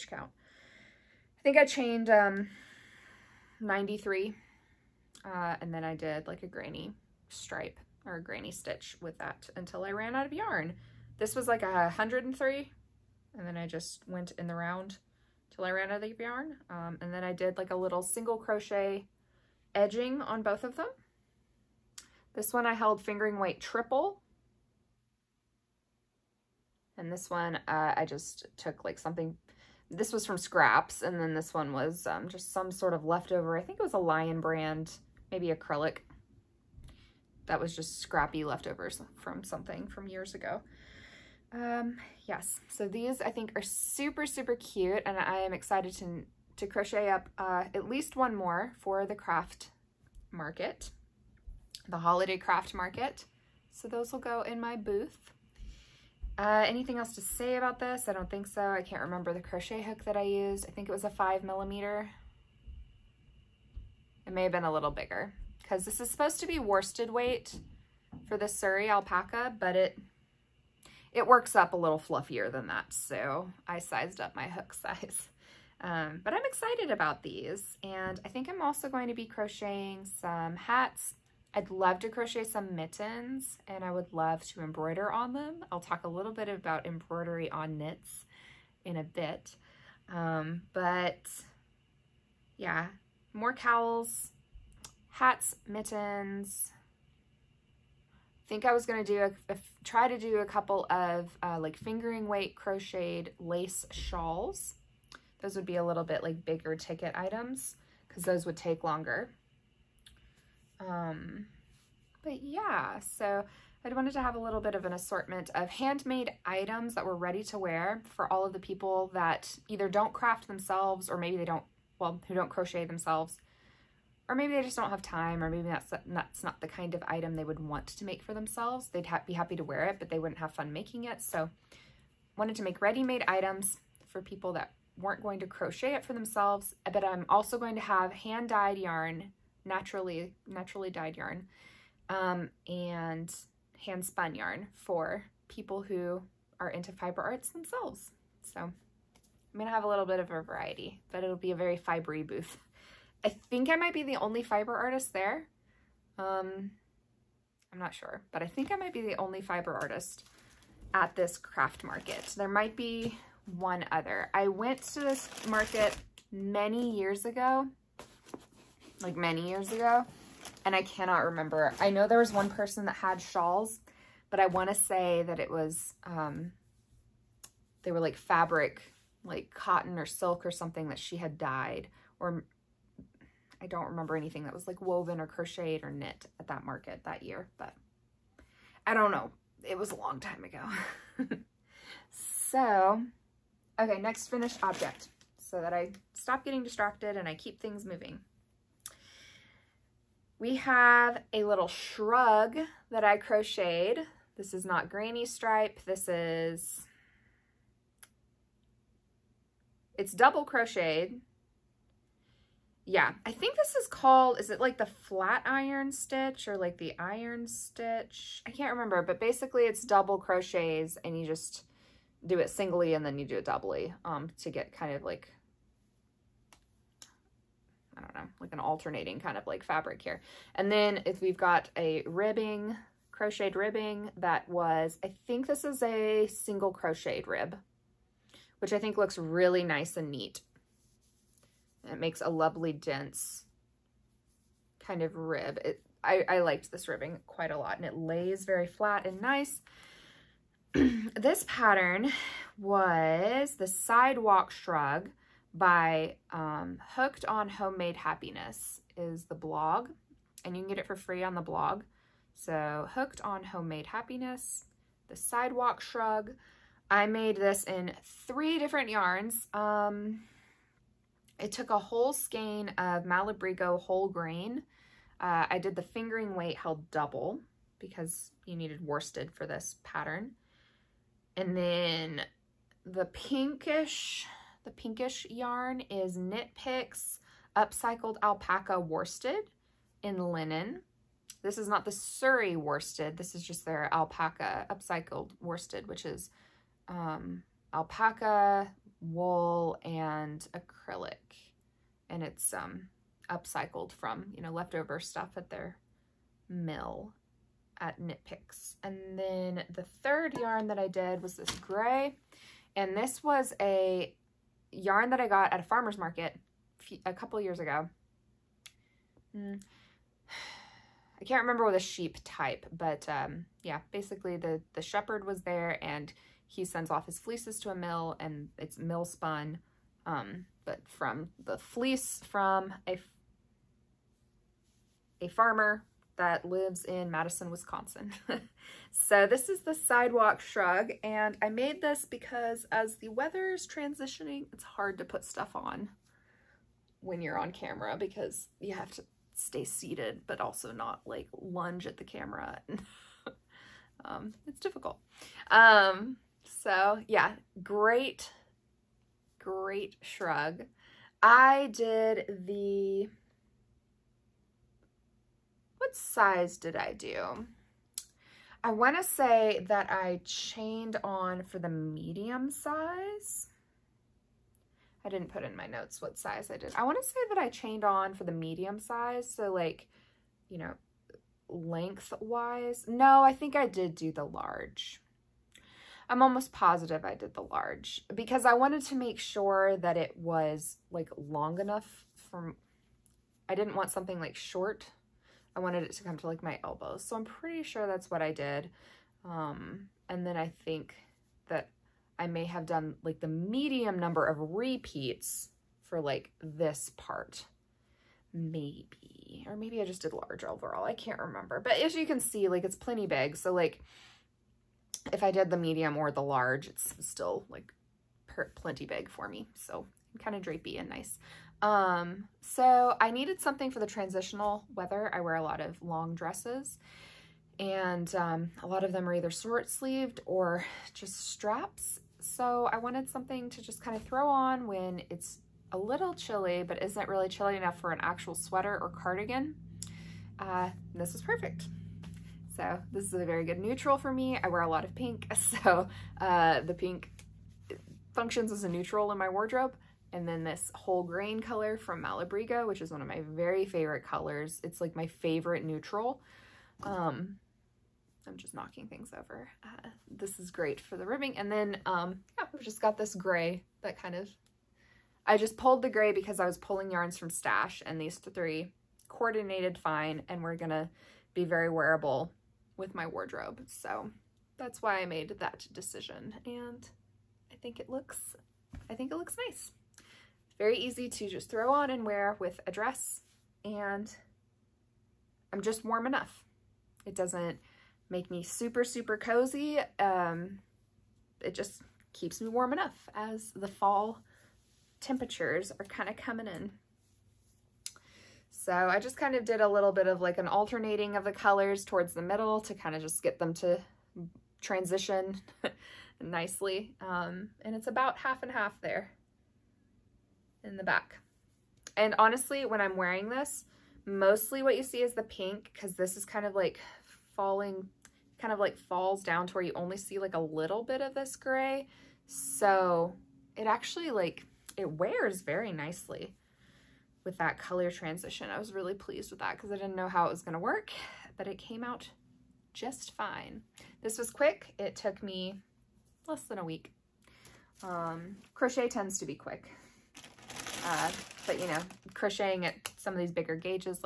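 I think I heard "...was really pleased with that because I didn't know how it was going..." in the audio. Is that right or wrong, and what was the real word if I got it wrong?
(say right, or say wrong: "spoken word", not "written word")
right.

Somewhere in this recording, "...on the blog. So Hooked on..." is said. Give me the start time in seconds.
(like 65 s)
261 s.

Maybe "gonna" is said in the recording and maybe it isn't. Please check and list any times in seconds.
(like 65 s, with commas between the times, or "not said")
149 s, 470 s.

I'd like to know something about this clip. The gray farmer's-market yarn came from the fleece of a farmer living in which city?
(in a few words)
Madison, Wisconsin.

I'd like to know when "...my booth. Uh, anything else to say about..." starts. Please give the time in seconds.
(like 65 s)
54 s.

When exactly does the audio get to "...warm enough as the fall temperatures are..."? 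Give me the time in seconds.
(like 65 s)
492 s.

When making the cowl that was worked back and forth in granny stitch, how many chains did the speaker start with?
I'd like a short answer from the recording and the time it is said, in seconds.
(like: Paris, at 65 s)
93, at 3 s.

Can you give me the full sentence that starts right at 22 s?
This one I held fingering weight triple.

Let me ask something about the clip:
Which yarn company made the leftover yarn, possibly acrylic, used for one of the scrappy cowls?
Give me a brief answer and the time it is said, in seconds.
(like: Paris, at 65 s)
Lion Brand, at 33 s.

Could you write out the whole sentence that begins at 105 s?
Those would be a little bit like bigger ticket items because those would take longer.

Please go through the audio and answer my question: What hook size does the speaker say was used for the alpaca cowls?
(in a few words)
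5 millimeter.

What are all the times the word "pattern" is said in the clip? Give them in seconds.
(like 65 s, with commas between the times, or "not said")
251 s, 279 s.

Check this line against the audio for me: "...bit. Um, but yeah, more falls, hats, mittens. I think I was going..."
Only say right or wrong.
wrong.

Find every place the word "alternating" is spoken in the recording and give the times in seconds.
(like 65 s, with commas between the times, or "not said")
228 s, 500 s.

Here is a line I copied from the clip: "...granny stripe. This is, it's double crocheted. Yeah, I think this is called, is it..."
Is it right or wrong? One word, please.
right.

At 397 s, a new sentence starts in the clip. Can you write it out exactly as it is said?
So I'm pretty sure that's what I did.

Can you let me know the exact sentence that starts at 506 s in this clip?
Um, and it's about half and half there in the back.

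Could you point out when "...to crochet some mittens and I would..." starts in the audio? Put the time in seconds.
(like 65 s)
81 s.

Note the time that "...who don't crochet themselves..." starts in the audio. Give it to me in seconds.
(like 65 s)
122 s.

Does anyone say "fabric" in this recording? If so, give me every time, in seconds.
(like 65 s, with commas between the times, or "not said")
178 s, 229 s.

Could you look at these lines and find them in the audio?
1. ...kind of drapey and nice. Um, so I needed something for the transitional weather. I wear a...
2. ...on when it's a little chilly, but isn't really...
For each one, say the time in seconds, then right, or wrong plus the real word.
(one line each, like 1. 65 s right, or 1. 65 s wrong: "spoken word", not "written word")
1. 420 s right
2. 434 s right.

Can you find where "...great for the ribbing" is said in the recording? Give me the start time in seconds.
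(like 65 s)
460 s.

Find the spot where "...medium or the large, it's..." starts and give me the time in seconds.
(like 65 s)
415 s.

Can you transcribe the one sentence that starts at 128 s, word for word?
They'd ha be happy to wear it, but they wouldn't have fun making it.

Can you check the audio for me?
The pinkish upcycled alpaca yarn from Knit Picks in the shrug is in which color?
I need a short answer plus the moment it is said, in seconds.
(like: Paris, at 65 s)
Linen, at 290 s.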